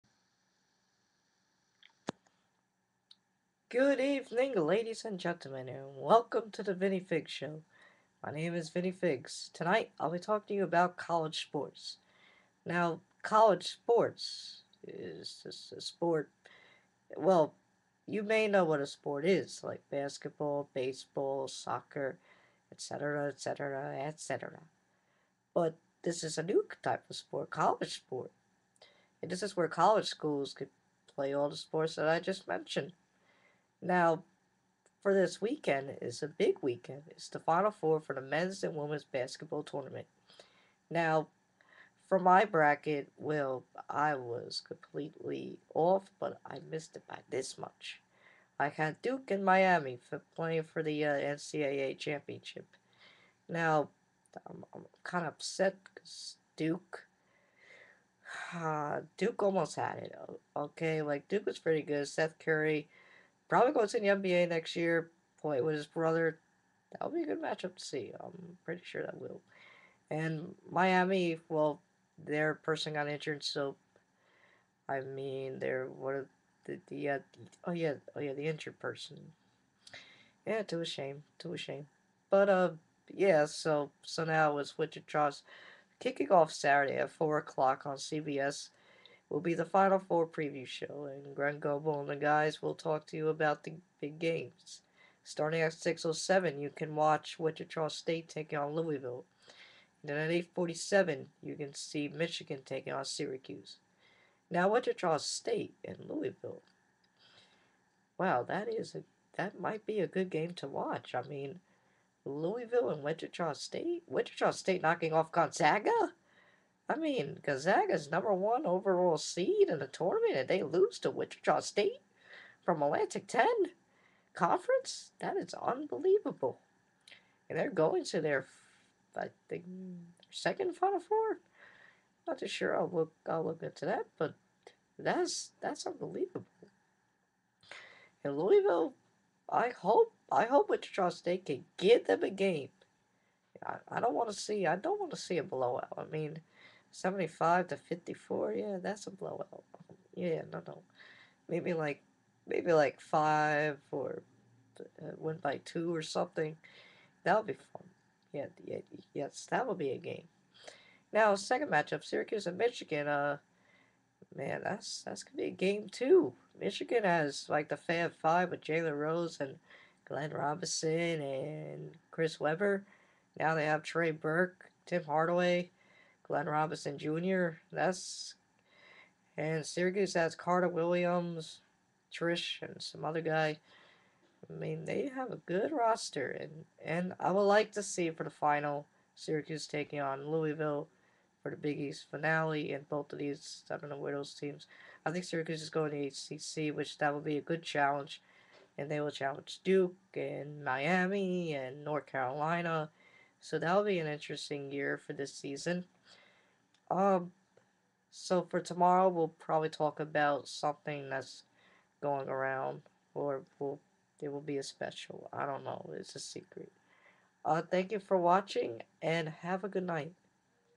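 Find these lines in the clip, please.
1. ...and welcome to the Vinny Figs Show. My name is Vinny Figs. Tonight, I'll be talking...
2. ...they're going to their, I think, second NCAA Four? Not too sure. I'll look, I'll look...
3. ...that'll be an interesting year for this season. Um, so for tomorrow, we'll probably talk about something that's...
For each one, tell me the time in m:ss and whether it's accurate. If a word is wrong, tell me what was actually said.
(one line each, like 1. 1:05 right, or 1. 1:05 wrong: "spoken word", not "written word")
1. 0:05 right
2. 2:07 wrong: "Final", not "NCAA"
3. 3:23 right.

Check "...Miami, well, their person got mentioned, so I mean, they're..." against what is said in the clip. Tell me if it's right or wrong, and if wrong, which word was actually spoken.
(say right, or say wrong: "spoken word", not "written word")
wrong: "injured", not "mentioned".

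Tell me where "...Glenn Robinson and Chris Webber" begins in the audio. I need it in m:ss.
2:50.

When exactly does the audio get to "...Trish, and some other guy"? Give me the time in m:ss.
3:02.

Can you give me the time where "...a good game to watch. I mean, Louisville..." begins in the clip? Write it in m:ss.
1:49.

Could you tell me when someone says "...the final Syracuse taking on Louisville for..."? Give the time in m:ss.
3:08.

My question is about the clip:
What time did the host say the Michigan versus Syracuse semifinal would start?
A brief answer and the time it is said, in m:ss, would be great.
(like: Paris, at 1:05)
8:47, at 1:40.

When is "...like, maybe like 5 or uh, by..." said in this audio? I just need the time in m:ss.
2:31.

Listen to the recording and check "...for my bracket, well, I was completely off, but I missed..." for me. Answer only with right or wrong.
right.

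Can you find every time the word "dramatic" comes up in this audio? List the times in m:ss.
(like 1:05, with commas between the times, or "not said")
not said.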